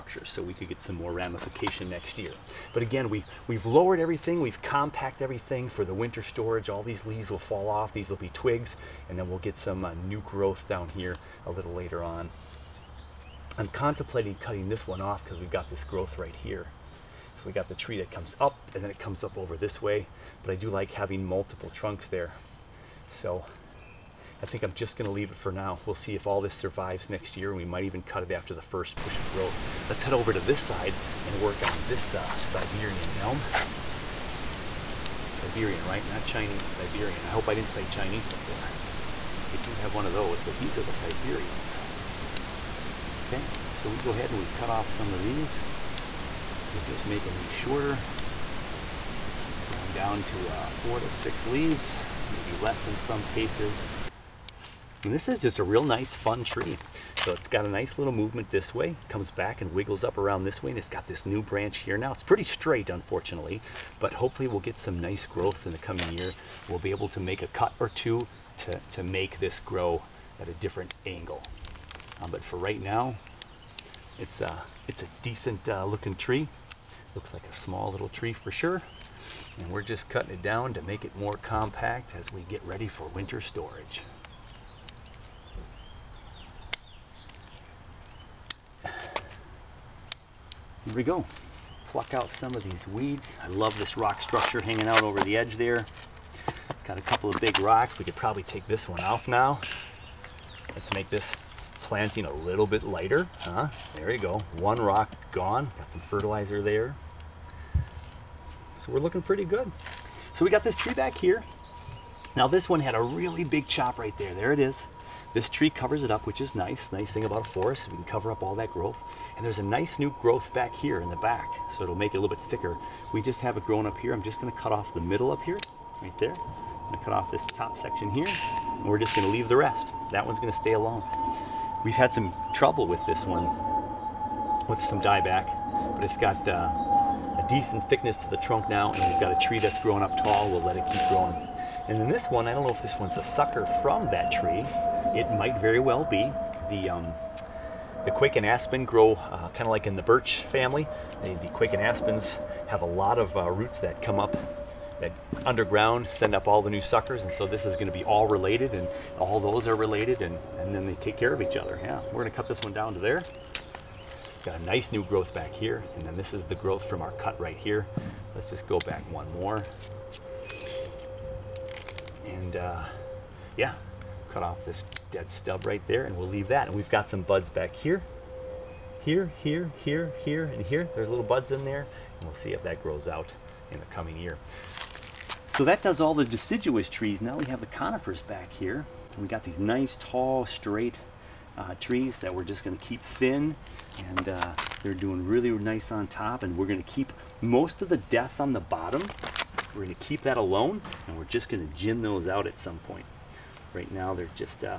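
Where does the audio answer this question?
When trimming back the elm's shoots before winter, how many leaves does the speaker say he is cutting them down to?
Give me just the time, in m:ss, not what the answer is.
0:50.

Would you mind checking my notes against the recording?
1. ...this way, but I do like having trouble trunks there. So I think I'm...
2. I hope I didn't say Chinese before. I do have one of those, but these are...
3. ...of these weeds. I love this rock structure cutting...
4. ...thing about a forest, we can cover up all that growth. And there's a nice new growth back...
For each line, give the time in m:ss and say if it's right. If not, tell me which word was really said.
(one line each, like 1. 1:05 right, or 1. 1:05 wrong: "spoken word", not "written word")
1. 0:19 wrong: "multiple", not "trouble"
2. 0:37 right
3. 1:32 wrong: "hanging", not "cutting"
4. 1:57 right.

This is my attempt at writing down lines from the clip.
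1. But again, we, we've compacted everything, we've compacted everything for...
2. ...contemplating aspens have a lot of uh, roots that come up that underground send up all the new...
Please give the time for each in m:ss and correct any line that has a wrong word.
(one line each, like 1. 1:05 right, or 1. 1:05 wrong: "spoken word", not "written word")
1. 0:02 wrong: "lowered", not "compacted"
2. 2:31 wrong: "quaking", not "contemplating".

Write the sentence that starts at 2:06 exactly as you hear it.
I'm gonna cut off this top section here, and we're just gonna leave the rest.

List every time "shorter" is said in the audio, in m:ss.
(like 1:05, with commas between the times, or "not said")
0:47.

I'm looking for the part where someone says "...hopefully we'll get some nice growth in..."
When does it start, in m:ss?
1:04.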